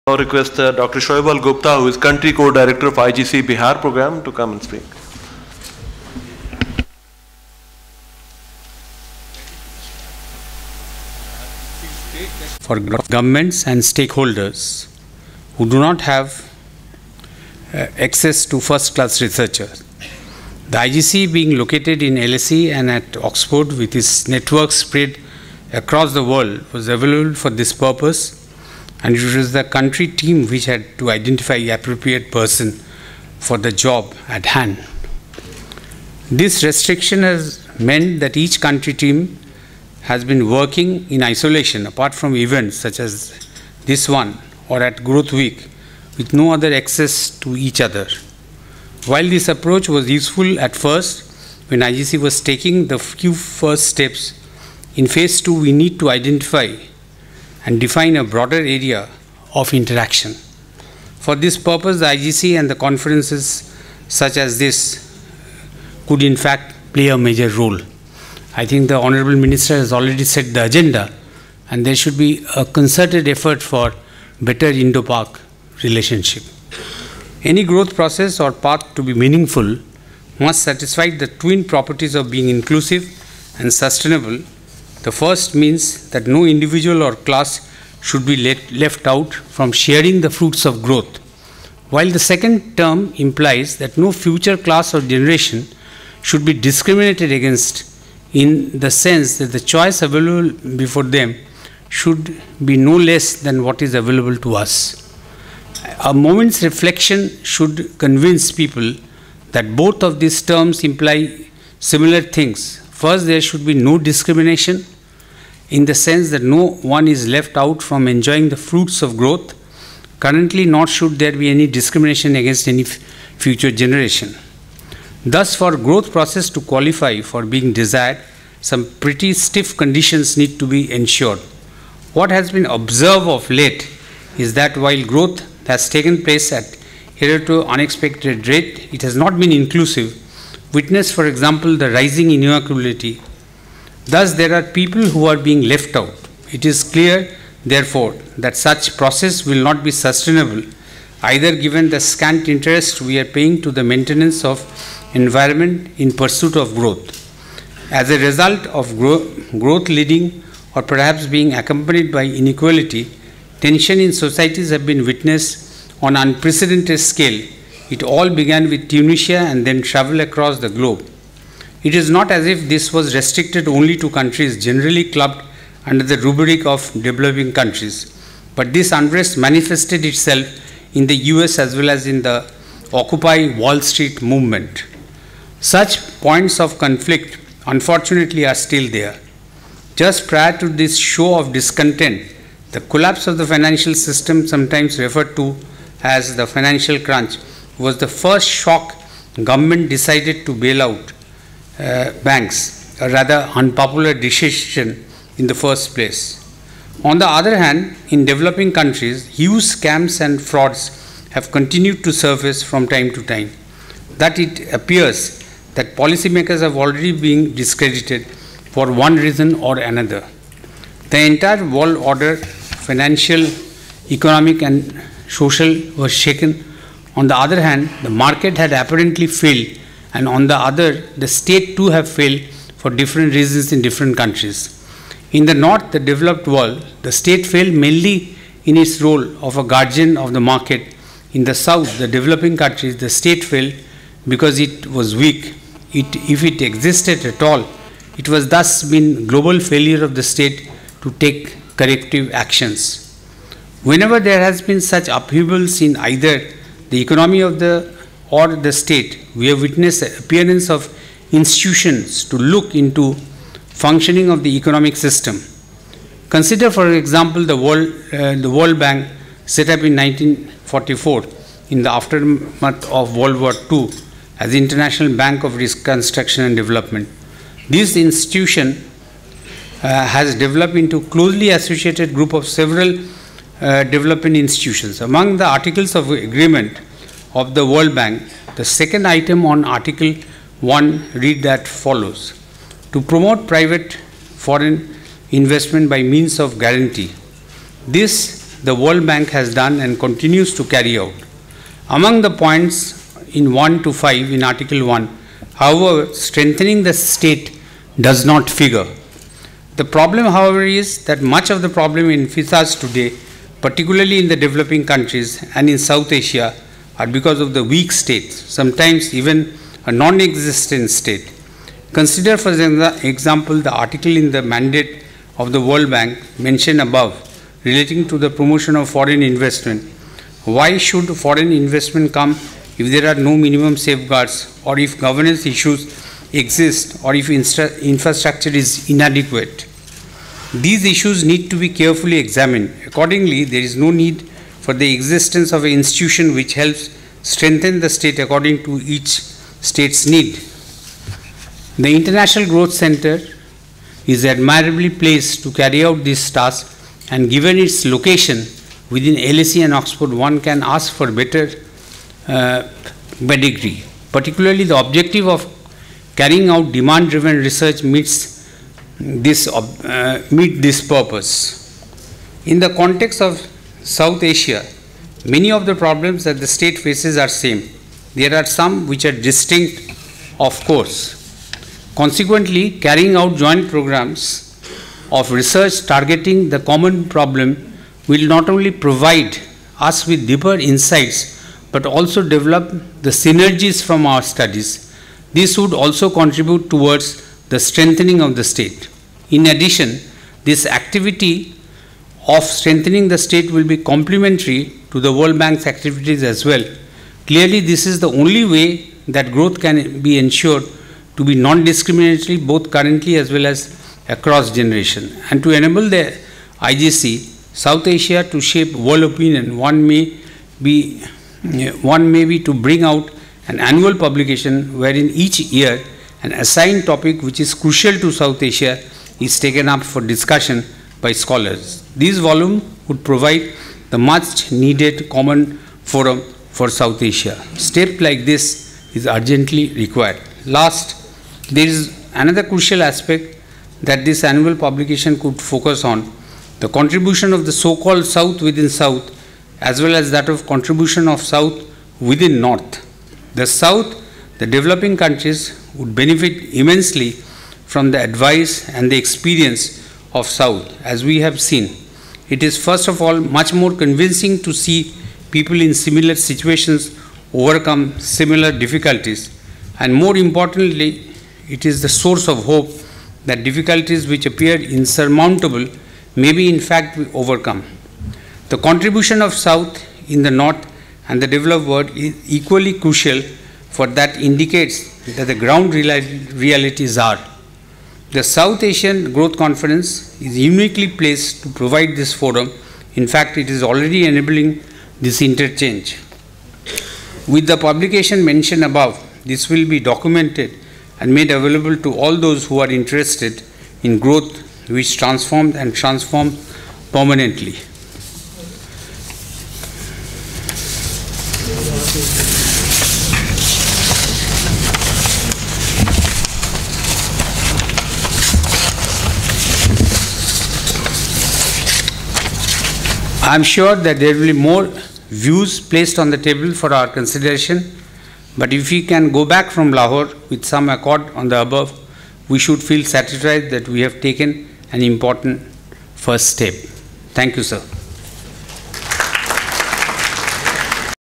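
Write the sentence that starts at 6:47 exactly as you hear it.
Clearly, this is the only way that growth can be ensured to be non-discriminatory both currently as well as across generation.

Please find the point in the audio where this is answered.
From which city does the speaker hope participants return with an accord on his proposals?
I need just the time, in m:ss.
8:49.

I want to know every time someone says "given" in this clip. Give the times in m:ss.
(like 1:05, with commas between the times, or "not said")
2:31, 5:57.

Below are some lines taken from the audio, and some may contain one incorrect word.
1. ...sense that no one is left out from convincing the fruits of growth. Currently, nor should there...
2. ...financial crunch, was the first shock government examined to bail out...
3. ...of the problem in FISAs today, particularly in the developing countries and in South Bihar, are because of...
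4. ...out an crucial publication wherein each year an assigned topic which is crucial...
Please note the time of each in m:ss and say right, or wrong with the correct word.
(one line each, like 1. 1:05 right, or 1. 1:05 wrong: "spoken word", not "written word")
1. 1:55 wrong: "enjoying", not "convincing"
2. 3:16 wrong: "decided", not "examined"
3. 5:11 wrong: "Asia", not "Bihar"
4. 7:02 wrong: "annual", not "crucial".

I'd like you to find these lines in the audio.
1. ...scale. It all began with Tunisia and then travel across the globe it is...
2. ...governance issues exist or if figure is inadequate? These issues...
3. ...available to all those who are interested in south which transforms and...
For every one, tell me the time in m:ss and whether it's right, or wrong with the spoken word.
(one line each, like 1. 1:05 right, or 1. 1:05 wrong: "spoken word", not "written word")
1. 2:46 right
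2. 5:34 wrong: "infrastructure", not "figure"
3. 8:21 wrong: "growth", not "south".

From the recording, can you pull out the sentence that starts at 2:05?
Thus, for growth process to qualify for being desired, some pretty stiff conditions need to be ensured.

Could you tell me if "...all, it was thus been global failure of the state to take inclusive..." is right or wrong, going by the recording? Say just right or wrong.
wrong.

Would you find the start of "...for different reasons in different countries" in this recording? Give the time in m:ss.
3:52.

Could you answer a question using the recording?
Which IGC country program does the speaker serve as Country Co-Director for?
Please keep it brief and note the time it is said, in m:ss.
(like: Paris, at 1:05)
Bihar, at 0:02.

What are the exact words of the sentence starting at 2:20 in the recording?
Witness, for example, the rising inequality Thus, there are people who are being left out.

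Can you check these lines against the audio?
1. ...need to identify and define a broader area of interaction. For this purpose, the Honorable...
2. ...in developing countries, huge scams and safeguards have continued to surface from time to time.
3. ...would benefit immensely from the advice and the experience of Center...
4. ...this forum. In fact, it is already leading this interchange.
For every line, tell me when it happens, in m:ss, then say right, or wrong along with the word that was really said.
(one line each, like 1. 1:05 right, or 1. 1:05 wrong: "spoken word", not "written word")
1. 0:55 wrong: "IGC", not "Honorable"
2. 3:28 wrong: "frauds", not "safeguards"
3. 7:35 wrong: "South", not "Center"
4. 8:11 wrong: "enabling", not "leading".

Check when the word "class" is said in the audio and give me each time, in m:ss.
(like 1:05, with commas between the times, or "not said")
0:18, 1:27, 1:34.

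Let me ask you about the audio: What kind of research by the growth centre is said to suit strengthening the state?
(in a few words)
Demand-driven research.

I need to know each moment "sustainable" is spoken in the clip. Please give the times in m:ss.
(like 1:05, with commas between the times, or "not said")
1:23, 2:29.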